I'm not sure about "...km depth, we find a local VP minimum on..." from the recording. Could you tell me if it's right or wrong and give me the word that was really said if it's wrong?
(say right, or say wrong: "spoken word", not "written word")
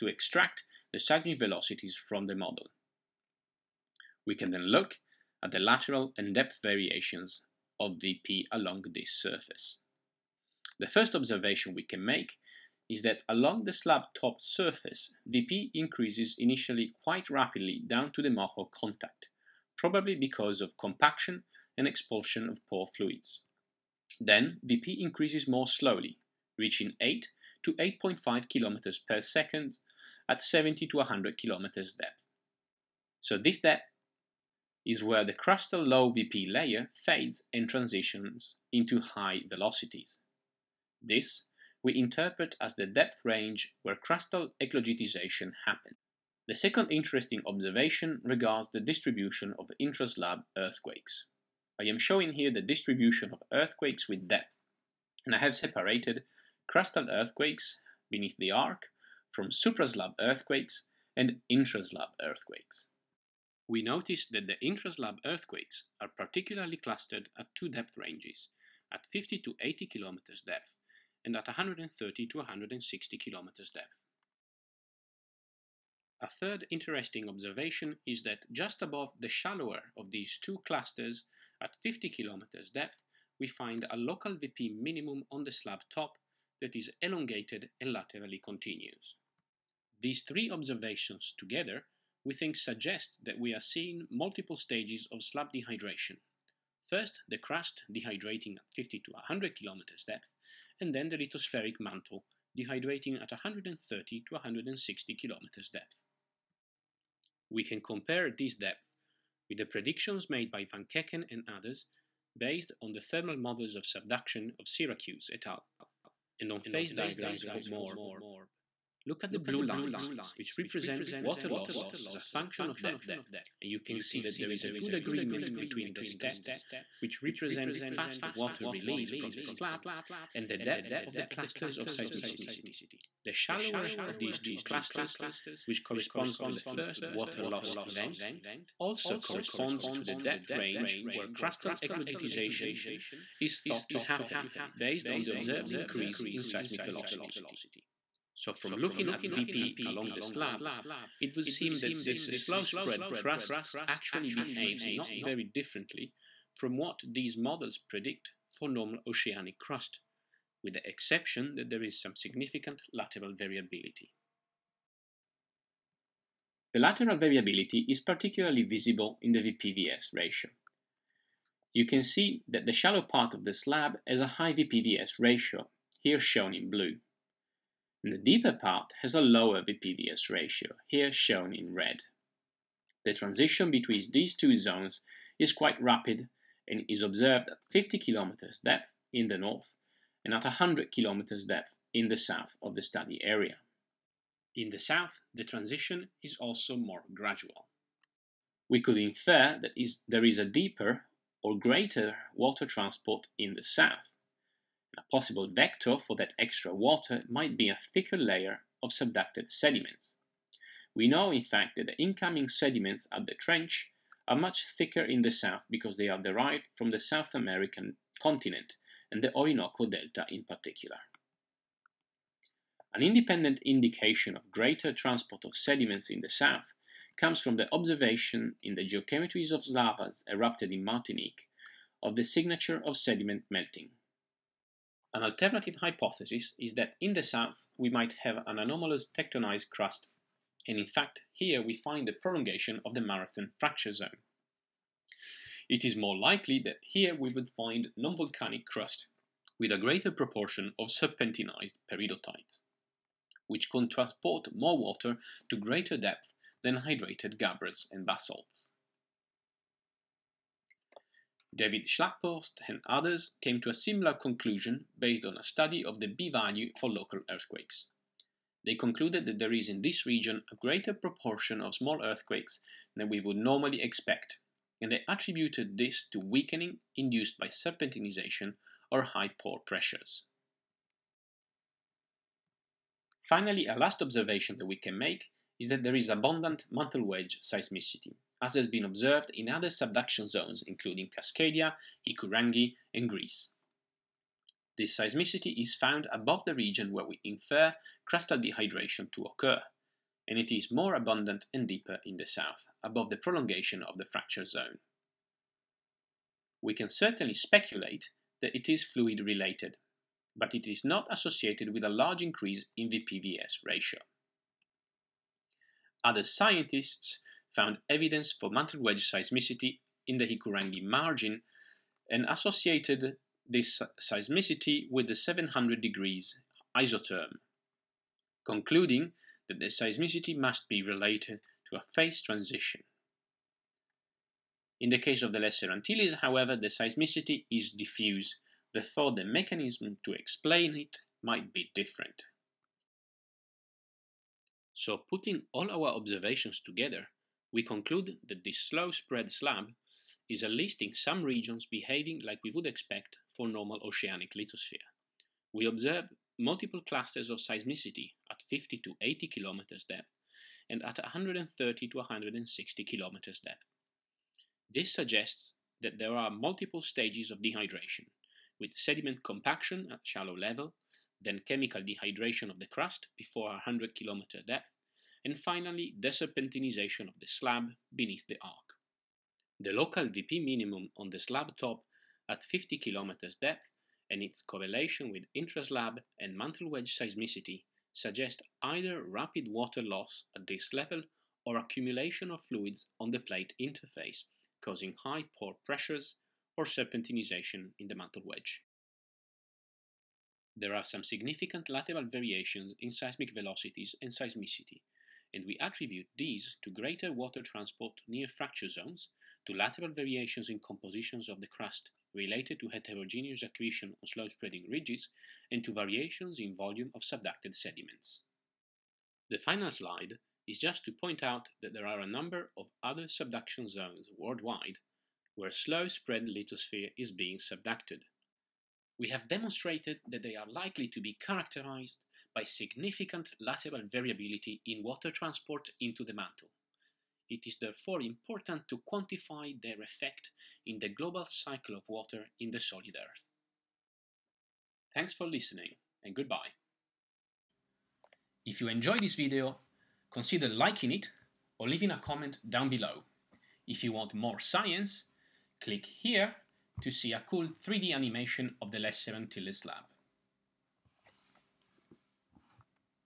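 right.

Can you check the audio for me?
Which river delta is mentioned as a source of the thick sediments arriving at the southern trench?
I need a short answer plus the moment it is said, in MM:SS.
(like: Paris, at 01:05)
Orinoco Delta, at 03:39.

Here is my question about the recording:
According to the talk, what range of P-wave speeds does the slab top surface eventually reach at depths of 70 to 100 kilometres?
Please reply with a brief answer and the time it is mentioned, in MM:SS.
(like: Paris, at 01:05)
8 to 8.5 km/s, at 00:26.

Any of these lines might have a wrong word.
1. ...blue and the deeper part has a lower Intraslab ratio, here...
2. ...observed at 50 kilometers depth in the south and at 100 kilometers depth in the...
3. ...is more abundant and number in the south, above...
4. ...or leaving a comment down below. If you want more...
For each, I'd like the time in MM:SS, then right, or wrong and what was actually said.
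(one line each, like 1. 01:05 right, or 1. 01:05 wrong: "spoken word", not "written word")
1. 02:56 wrong: "VPVS", not "Intraslab"
2. 03:07 wrong: "north", not "south"
3. 05:00 wrong: "deeper", not "number"
4. 07:31 right.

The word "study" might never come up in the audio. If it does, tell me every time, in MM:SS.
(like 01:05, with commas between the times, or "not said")
03:12, 04:25.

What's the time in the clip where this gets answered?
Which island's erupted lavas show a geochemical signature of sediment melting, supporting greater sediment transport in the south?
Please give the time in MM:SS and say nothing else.
03:50.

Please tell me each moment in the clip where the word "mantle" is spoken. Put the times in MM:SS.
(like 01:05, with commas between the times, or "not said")
01:41, 04:46, 05:18, 06:26, 06:37, 07:16.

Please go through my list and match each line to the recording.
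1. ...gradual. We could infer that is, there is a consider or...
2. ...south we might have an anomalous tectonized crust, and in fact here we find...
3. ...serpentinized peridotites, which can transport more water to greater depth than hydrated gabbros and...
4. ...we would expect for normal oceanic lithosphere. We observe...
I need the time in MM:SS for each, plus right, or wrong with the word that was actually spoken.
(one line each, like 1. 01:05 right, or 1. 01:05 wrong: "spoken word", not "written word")
1. 03:17 wrong: "deeper", not "consider"
2. 03:57 right
3. 04:10 right
4. 05:52 right.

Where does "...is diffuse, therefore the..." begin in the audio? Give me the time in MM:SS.
05:37.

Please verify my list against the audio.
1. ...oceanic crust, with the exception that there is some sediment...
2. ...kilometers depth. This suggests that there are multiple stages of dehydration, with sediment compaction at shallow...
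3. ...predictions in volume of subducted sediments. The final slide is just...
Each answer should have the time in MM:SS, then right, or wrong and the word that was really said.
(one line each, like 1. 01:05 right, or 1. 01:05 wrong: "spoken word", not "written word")
1. 02:39 wrong: "significant", not "sediment"
2. 06:02 right
3. 06:55 wrong: "variations", not "predictions".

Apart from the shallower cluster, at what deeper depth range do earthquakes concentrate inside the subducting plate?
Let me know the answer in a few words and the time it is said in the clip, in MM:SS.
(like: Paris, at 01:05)
130 to 160 km, at 01:11.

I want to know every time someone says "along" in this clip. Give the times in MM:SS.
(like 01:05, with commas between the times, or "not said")
00:08, 00:13, 02:29.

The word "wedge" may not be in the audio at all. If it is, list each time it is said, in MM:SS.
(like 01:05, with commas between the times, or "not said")
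04:47, 05:18, 06:26, 06:38.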